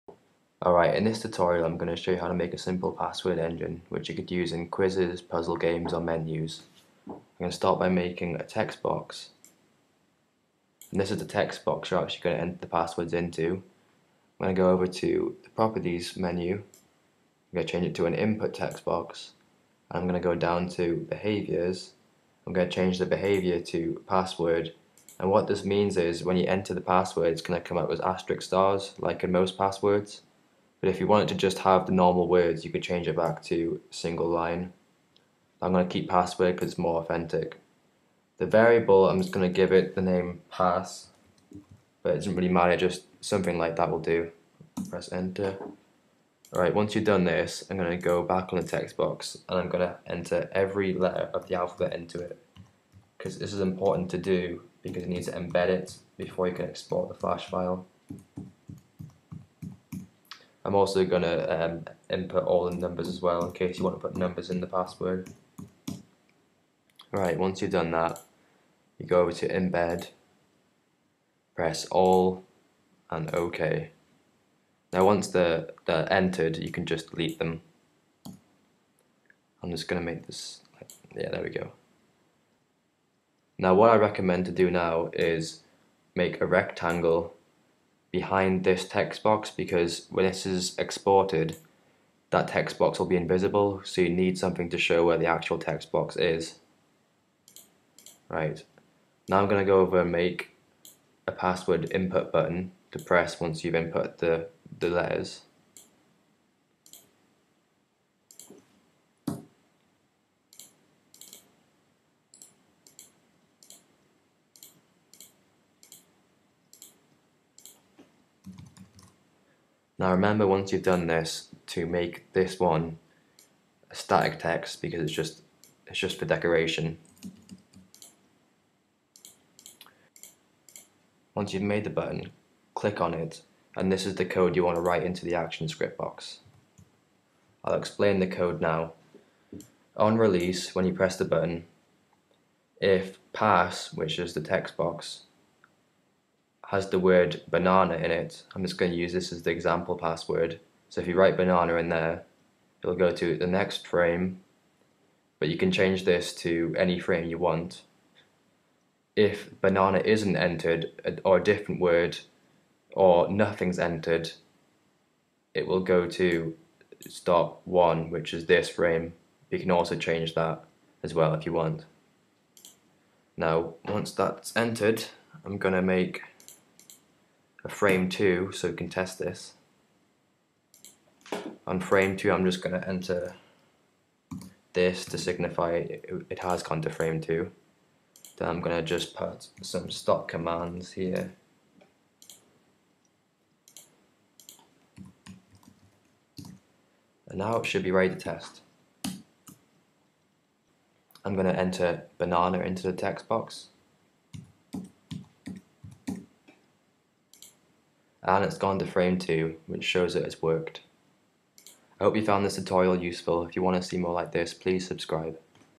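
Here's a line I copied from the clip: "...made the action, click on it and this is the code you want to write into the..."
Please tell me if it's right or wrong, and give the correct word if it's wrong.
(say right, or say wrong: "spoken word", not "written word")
wrong: "button", not "action".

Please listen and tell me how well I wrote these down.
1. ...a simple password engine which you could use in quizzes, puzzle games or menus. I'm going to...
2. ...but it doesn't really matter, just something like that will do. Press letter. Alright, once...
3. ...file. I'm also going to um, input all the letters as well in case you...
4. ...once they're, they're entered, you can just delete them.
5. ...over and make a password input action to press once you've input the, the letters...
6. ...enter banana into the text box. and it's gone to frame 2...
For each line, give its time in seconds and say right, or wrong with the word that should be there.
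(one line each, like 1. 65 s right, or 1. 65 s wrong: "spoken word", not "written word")
1. 2 s right
2. 42 s wrong: "enter", not "letter"
3. 57 s wrong: "numbers", not "letters"
4. 75 s right
5. 99 s wrong: "button", not "action"
6. 201 s right.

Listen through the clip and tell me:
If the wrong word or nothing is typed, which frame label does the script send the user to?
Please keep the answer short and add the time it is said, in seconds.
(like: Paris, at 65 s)
stop 1, at 167 s.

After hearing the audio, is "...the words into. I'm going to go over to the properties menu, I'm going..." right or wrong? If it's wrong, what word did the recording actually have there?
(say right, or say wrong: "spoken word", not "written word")
wrong: "passwords", not "words".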